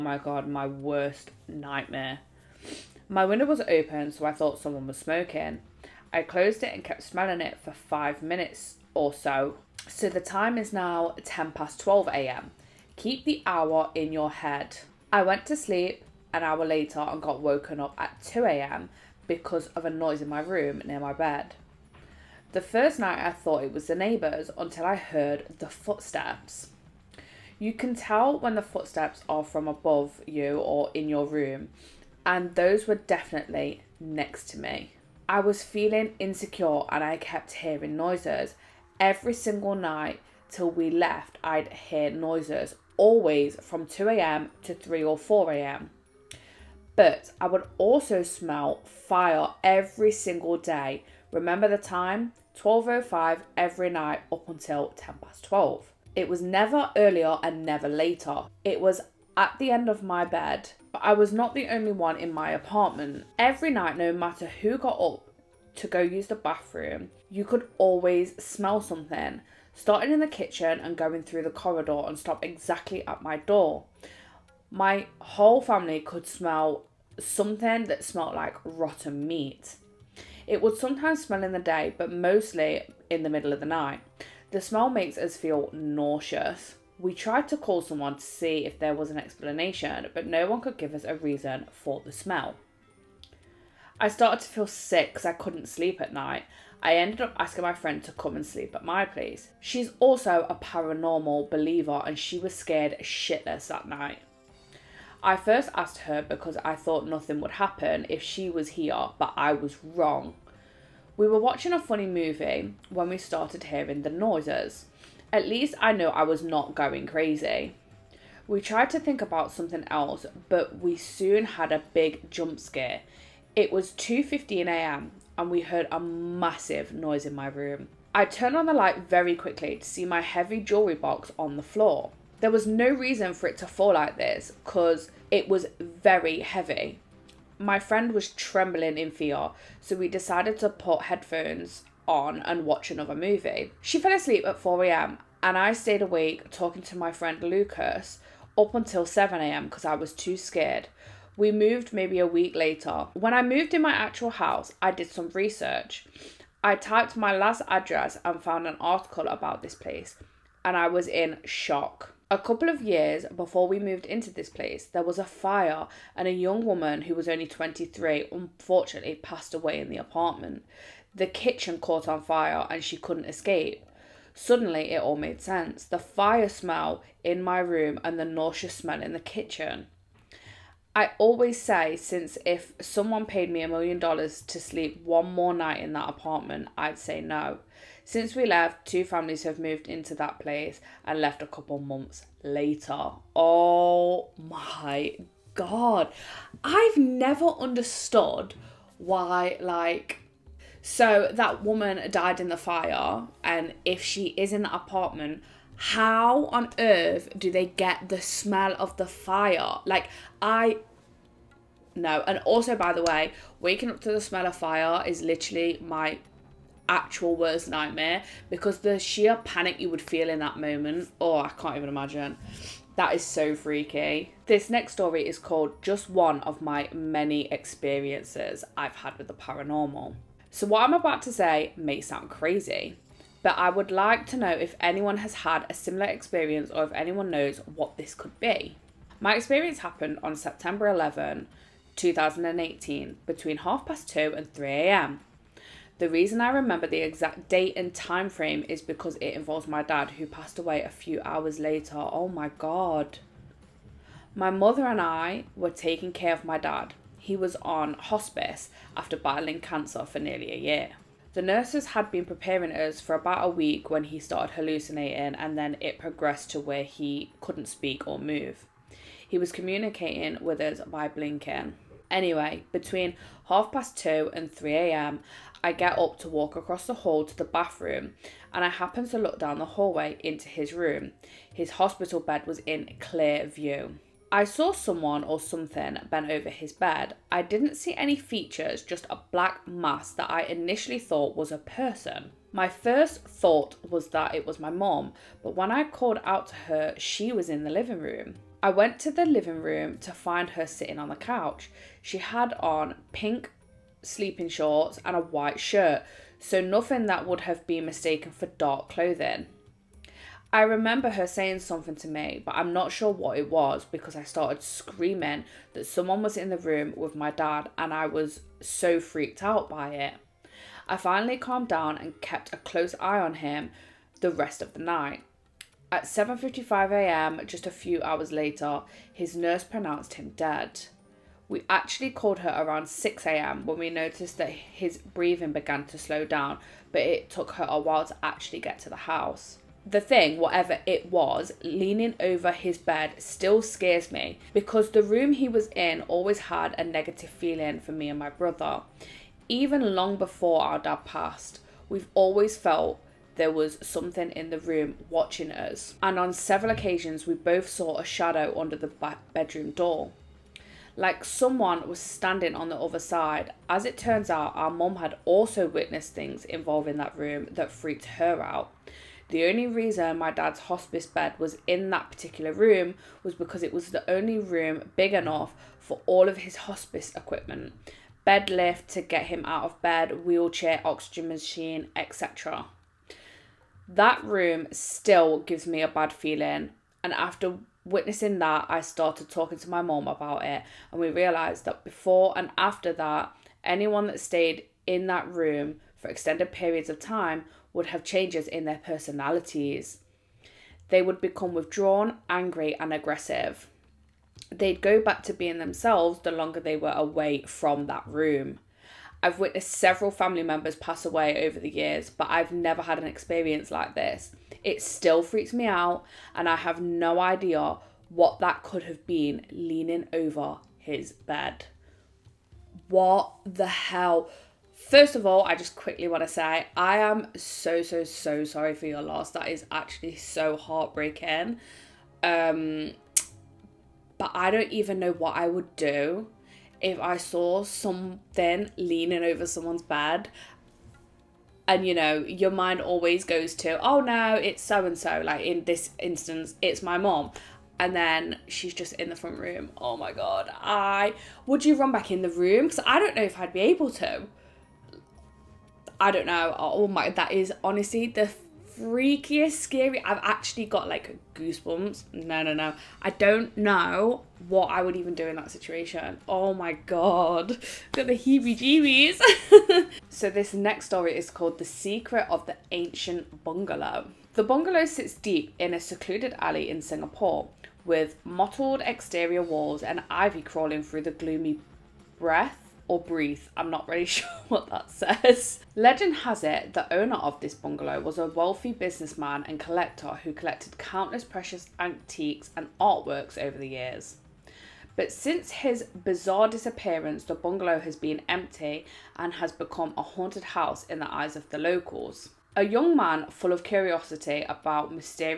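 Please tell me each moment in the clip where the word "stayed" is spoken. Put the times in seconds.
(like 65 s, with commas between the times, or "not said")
145 s, 394 s.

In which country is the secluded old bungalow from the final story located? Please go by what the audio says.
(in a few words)
Singapore.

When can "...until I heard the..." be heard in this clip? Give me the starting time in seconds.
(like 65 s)
24 s.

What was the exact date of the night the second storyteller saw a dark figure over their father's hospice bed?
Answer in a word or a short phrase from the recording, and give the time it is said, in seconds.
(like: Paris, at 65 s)
September 11, 2018, at 240 s.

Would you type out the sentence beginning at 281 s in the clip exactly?
His hospital bed was in clear view.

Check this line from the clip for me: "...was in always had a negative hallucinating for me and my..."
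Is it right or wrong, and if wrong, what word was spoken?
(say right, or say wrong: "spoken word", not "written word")
wrong: "feeling", not "hallucinating".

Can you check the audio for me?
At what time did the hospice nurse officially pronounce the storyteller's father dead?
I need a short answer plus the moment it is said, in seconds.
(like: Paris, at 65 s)
7:55 a.m., at 326 s.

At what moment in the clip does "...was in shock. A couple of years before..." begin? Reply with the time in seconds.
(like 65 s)
160 s.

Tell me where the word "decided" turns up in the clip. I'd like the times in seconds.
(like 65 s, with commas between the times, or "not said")
140 s.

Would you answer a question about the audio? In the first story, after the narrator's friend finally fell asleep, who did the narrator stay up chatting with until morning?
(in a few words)
Lucas.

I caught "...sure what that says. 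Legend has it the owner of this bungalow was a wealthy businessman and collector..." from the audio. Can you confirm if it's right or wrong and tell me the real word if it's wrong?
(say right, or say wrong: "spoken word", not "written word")
right.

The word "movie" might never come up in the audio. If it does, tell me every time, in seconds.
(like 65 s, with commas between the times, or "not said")
112 s, 143 s.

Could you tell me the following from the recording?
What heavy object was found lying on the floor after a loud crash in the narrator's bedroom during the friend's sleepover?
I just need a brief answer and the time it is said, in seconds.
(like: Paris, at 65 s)
jewelry box, at 130 s.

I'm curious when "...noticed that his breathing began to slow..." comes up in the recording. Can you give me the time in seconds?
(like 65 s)
333 s.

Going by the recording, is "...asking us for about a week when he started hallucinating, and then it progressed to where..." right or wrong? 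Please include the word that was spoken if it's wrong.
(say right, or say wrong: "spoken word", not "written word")
wrong: "preparing", not "asking".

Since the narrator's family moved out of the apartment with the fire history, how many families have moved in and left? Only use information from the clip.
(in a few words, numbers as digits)
2.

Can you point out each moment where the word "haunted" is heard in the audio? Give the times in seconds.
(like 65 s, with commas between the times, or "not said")
500 s.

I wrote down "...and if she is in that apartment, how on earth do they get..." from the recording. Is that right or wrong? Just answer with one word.
right.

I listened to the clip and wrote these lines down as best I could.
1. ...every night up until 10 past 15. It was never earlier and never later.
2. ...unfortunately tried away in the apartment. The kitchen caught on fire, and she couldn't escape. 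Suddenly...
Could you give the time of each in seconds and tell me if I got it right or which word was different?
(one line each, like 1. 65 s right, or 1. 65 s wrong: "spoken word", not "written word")
1. 53 s wrong: "12", not "15"
2. 168 s wrong: "passed", not "tried".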